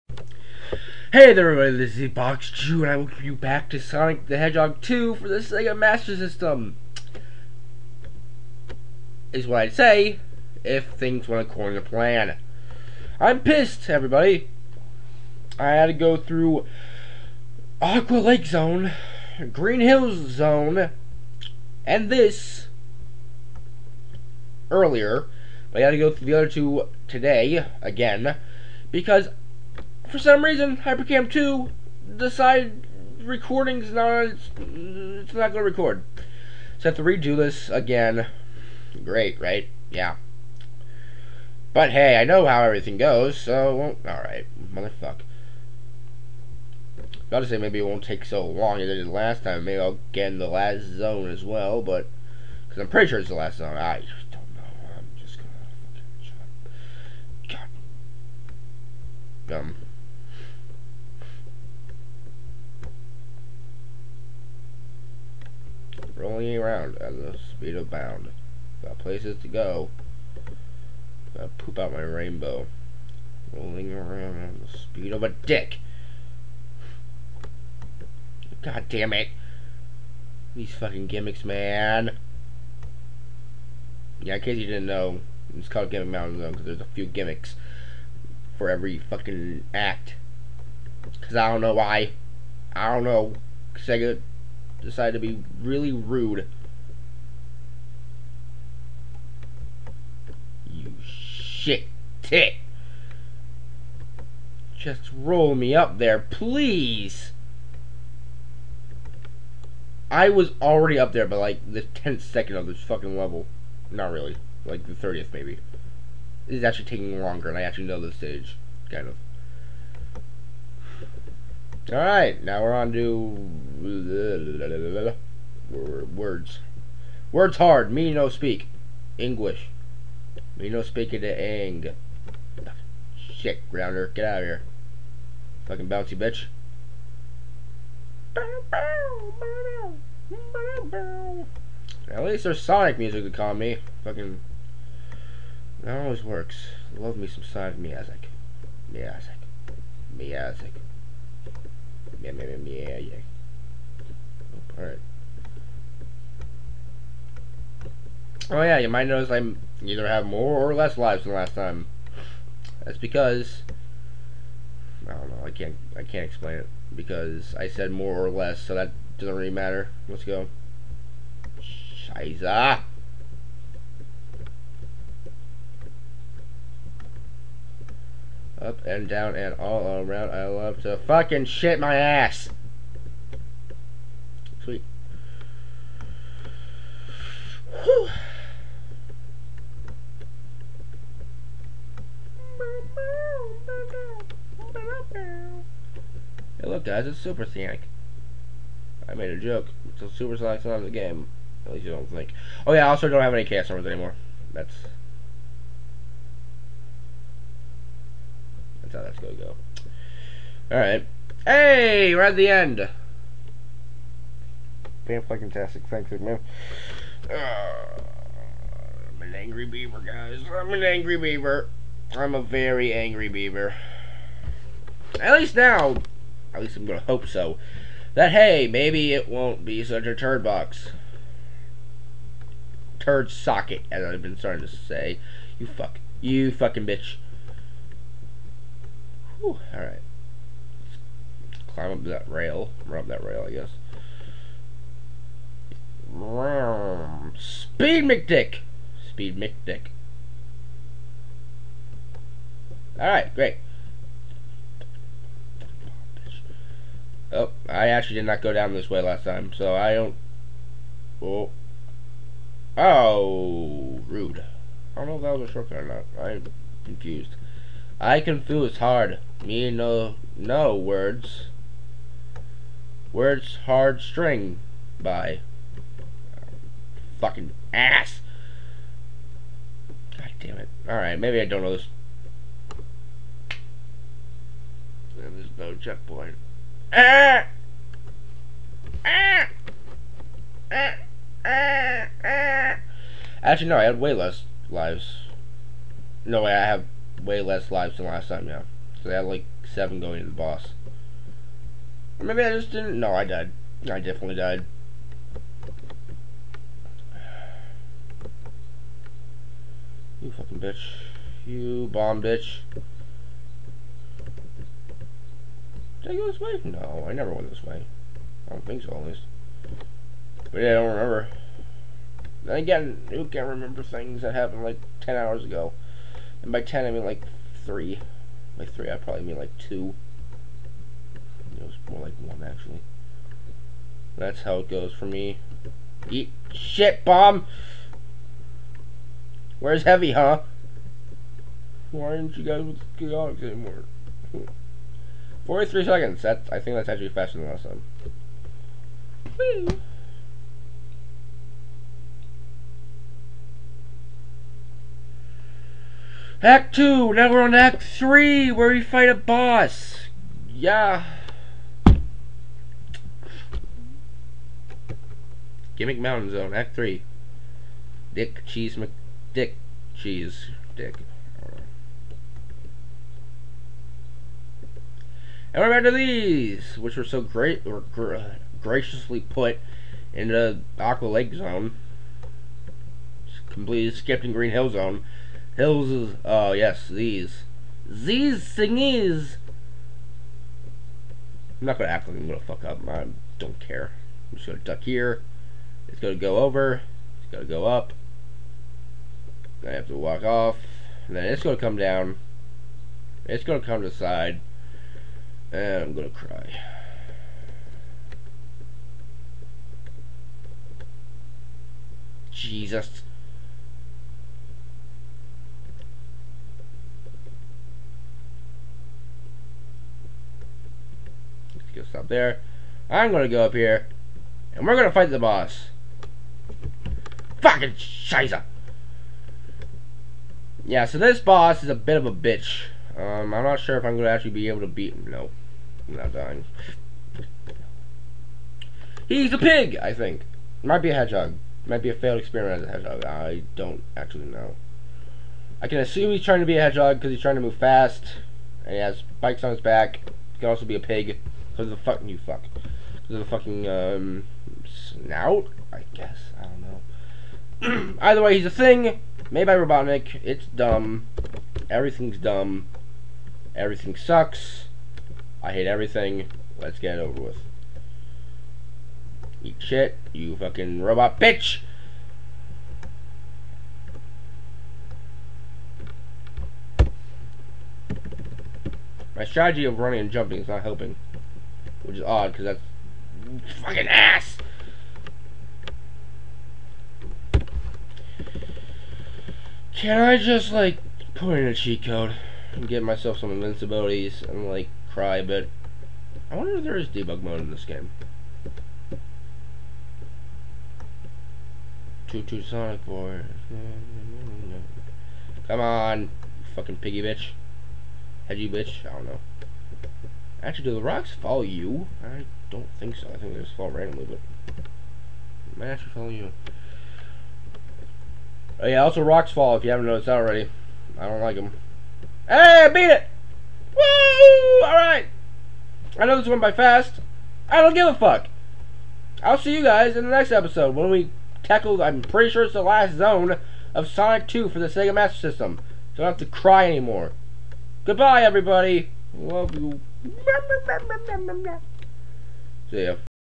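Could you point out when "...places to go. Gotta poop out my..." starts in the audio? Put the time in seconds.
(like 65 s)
68 s.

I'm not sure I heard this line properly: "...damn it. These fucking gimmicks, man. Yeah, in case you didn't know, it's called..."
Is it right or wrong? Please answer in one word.
right.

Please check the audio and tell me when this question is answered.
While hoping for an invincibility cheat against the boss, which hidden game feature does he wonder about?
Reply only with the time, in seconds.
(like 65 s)
496 s.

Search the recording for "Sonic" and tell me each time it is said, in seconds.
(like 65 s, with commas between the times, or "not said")
3 s, 142 s, 147 s, 197 s, 502 s, 533 s.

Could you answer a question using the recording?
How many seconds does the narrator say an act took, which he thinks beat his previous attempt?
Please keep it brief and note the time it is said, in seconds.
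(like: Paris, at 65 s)
43, at 345 s.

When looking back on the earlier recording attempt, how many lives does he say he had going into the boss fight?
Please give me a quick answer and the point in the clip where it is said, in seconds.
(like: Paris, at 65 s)
7, at 299 s.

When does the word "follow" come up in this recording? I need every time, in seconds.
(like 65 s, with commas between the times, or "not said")
511 s, 515 s.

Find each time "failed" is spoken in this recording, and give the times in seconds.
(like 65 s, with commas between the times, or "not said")
441 s.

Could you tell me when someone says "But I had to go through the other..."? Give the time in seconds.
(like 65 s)
25 s.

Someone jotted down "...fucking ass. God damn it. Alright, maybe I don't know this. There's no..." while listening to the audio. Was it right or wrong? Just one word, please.
right.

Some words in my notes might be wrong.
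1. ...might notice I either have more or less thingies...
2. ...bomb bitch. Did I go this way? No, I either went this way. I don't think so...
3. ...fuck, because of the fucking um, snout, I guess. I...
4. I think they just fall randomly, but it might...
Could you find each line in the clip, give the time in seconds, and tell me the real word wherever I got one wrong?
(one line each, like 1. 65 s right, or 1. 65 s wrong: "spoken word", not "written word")
1. 158 s wrong: "lives", not "thingies"
2. 311 s wrong: "never", not "either"
3. 452 s right
4. 513 s right.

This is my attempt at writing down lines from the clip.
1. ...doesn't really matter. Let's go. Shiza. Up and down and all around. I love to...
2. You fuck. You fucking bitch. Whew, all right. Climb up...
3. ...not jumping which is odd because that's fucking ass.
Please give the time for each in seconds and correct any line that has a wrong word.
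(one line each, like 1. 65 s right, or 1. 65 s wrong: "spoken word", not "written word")
1. 169 s right
2. 235 s right
3. 480 s wrong: "helping", not "jumping".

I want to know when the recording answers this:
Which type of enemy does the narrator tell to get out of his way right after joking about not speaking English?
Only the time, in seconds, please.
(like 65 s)
133 s.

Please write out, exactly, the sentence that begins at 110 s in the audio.
I was already up there by like the 10th second of this fucking level.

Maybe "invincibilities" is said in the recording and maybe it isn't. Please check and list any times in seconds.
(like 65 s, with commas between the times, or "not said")
493 s.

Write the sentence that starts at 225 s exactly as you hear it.
At least now, at least I'm gonna hope so, that hey, maybe it won't be such a turd box.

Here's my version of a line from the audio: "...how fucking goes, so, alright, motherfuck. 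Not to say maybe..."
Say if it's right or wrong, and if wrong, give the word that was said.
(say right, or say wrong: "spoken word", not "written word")
wrong: "everything", not "fucking".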